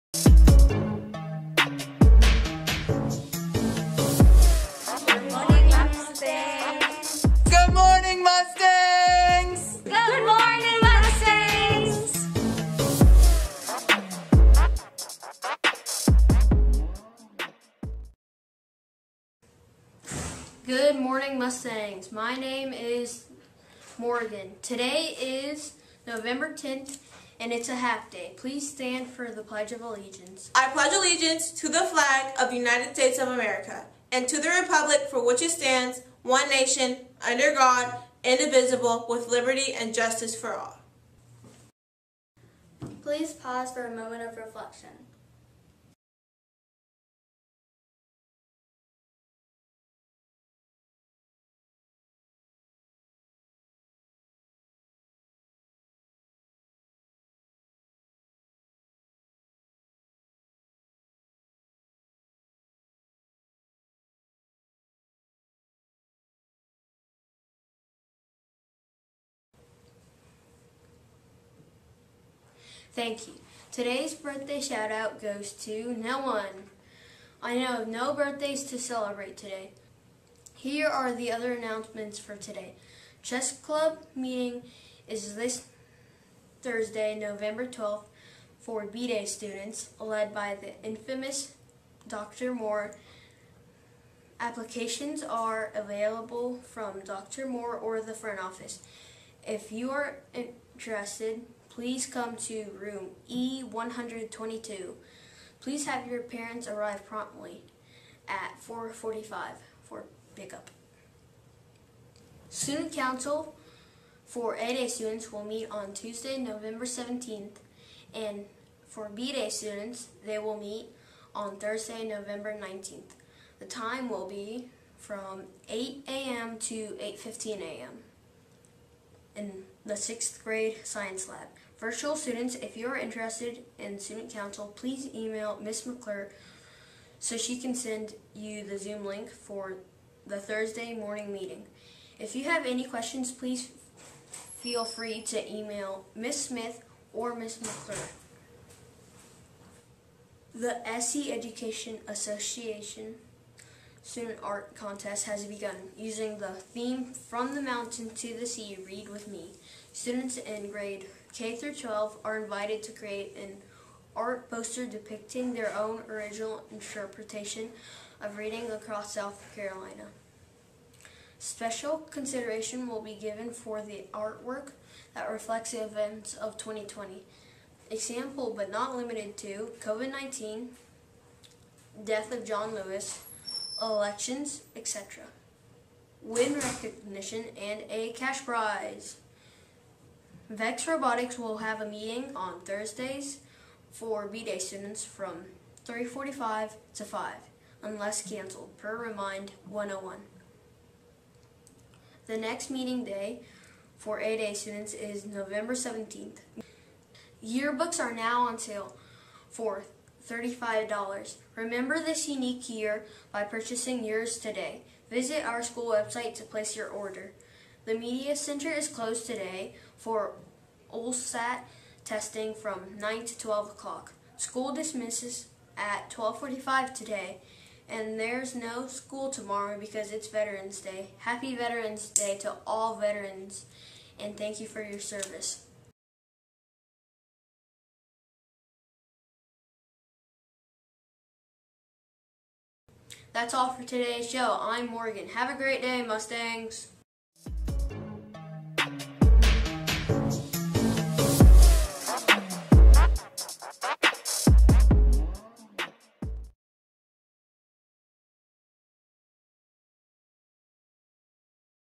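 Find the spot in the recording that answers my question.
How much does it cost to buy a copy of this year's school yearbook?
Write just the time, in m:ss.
3:30.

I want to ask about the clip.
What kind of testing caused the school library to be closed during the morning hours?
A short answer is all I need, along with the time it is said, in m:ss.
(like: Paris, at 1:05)
OLSAT, at 3:40.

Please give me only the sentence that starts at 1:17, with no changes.
I know of no birthdays to celebrate today.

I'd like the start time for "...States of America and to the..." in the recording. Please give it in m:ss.
0:32.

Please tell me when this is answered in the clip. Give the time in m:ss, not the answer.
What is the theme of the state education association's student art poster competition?
2:37.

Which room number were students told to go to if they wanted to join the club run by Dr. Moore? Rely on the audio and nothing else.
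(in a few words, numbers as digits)
E122.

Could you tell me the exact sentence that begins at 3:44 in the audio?
School dismisses at 1245 today, and there's no school tomorrow because it's Veterans Day.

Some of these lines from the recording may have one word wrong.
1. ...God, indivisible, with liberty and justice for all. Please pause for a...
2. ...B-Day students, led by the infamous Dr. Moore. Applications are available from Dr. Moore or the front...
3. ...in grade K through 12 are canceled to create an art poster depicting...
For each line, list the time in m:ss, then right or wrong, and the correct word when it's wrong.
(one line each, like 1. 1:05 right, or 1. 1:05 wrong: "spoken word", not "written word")
1. 0:37 right
2. 1:28 right
3. 2:40 wrong: "invited", not "canceled".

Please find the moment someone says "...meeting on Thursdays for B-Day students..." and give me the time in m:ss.
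3:11.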